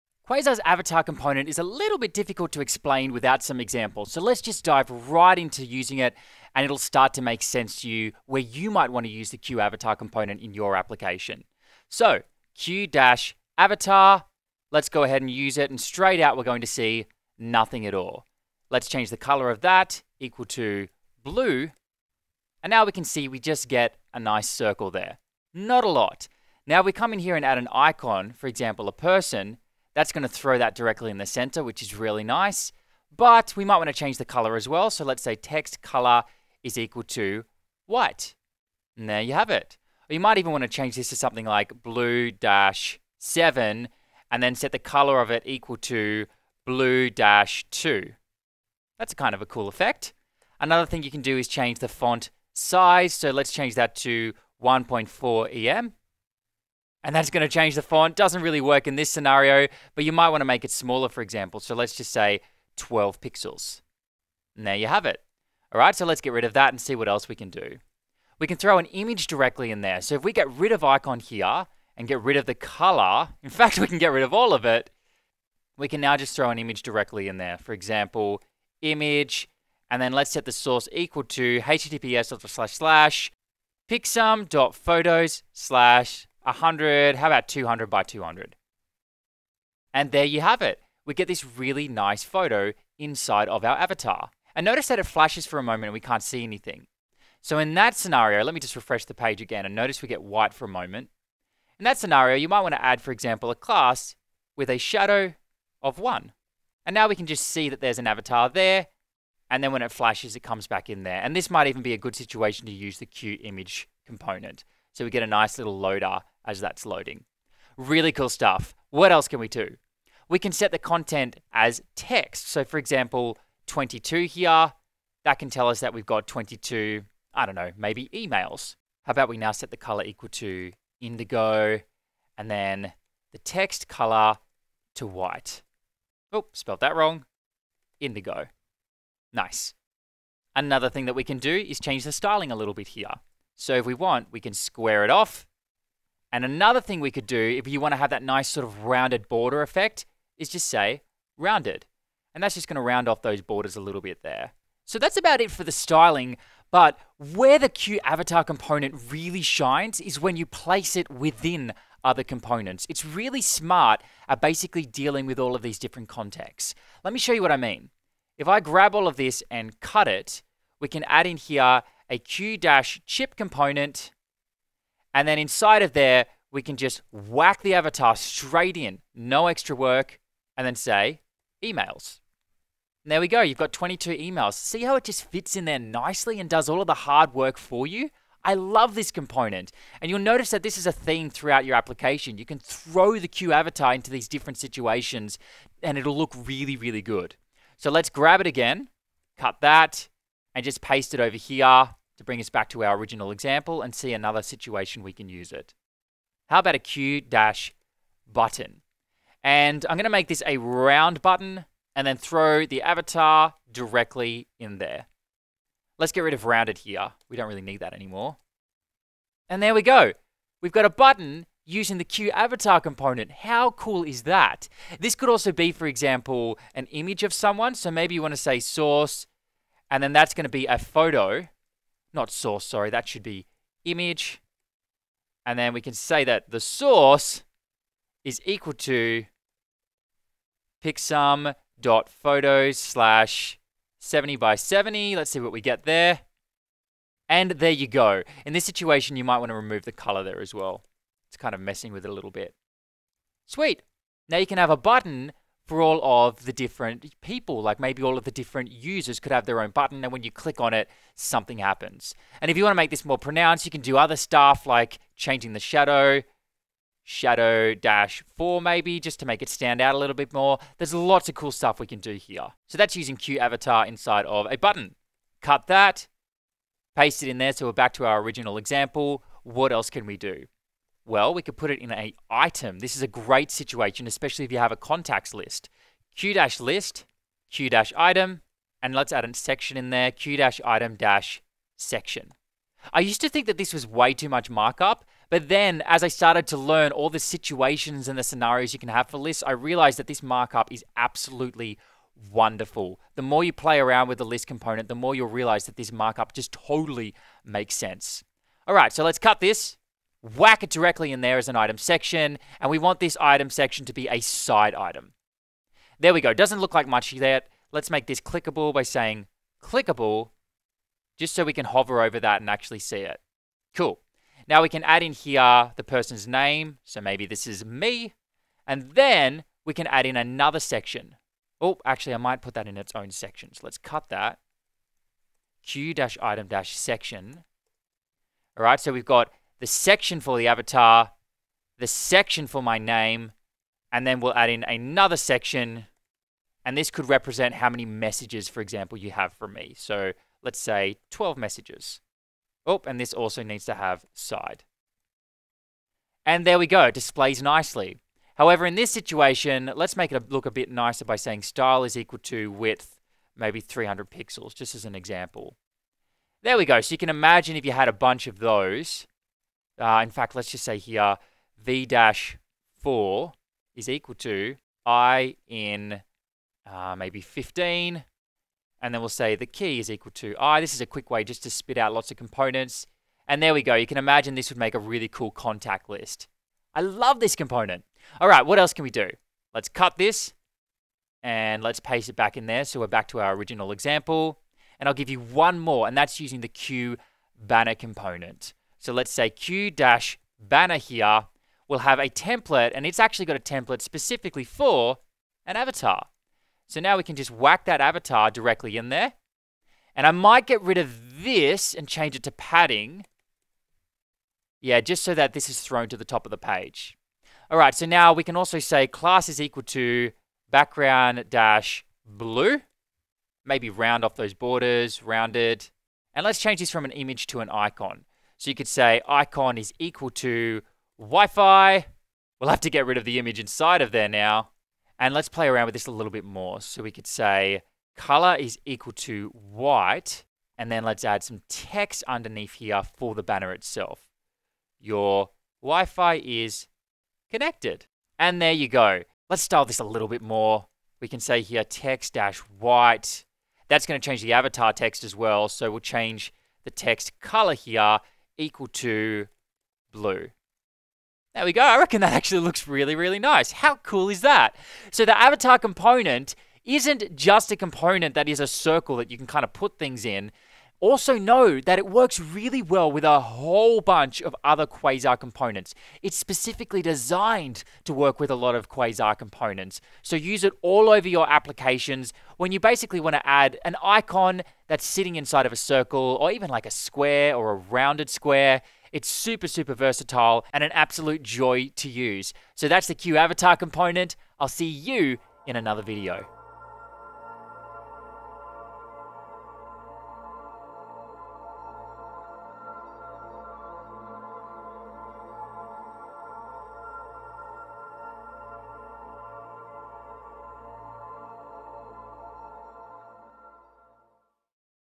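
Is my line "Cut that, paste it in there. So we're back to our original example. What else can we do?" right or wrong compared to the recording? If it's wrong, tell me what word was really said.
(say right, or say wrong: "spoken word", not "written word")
right.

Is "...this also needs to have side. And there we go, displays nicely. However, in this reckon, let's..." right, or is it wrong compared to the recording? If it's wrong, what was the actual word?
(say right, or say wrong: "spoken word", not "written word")
wrong: "situation", not "reckon".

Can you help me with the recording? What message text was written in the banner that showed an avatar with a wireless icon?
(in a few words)
Your Wi-Fi is connected.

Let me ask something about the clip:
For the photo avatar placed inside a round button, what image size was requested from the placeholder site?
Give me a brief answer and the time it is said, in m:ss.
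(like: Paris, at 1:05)
70 by 70, at 4:03.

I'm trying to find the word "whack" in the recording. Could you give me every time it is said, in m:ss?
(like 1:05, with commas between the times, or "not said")
2:57, 5:10, 6:47.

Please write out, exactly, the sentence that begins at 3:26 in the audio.
How about a Q dash button?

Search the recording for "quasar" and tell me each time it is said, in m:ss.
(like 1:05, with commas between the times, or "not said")
0:00, 7:54, 7:58.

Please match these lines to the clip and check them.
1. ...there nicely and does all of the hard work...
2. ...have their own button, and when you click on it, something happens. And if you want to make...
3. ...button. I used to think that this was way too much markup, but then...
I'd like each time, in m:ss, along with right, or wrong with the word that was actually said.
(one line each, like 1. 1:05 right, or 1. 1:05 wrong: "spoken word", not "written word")
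1. 3:05 right
2. 4:19 right
3. 4:51 wrong: "section", not "button".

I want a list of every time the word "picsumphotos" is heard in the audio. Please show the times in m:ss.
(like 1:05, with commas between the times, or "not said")
1:23, 4:00.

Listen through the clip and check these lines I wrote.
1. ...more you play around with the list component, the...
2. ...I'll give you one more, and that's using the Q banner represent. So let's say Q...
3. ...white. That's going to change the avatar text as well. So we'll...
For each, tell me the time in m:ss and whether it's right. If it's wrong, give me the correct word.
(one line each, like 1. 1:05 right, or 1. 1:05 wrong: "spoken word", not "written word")
1. 5:03 right
2. 6:34 wrong: "component", not "represent"
3. 7:32 right.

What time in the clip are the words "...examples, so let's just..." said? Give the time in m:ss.
0:03.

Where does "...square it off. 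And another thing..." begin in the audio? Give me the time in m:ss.
2:24.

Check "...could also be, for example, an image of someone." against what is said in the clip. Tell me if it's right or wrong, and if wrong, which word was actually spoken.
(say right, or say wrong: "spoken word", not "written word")
right.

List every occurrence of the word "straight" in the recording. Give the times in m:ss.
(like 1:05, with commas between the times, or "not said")
0:15, 2:58.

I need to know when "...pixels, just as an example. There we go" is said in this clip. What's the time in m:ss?
6:04.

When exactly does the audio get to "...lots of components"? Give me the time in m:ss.
6:21.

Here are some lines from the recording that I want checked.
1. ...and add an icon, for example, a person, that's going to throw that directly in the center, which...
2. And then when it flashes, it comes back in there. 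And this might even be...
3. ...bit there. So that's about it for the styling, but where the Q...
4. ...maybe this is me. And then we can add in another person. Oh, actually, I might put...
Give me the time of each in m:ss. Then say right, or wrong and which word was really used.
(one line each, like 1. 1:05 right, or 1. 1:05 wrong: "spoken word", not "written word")
1. 0:27 right
2. 1:49 right
3. 2:34 right
4. 5:26 wrong: "section", not "person".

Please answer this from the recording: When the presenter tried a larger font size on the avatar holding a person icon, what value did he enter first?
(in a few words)
1.4 em.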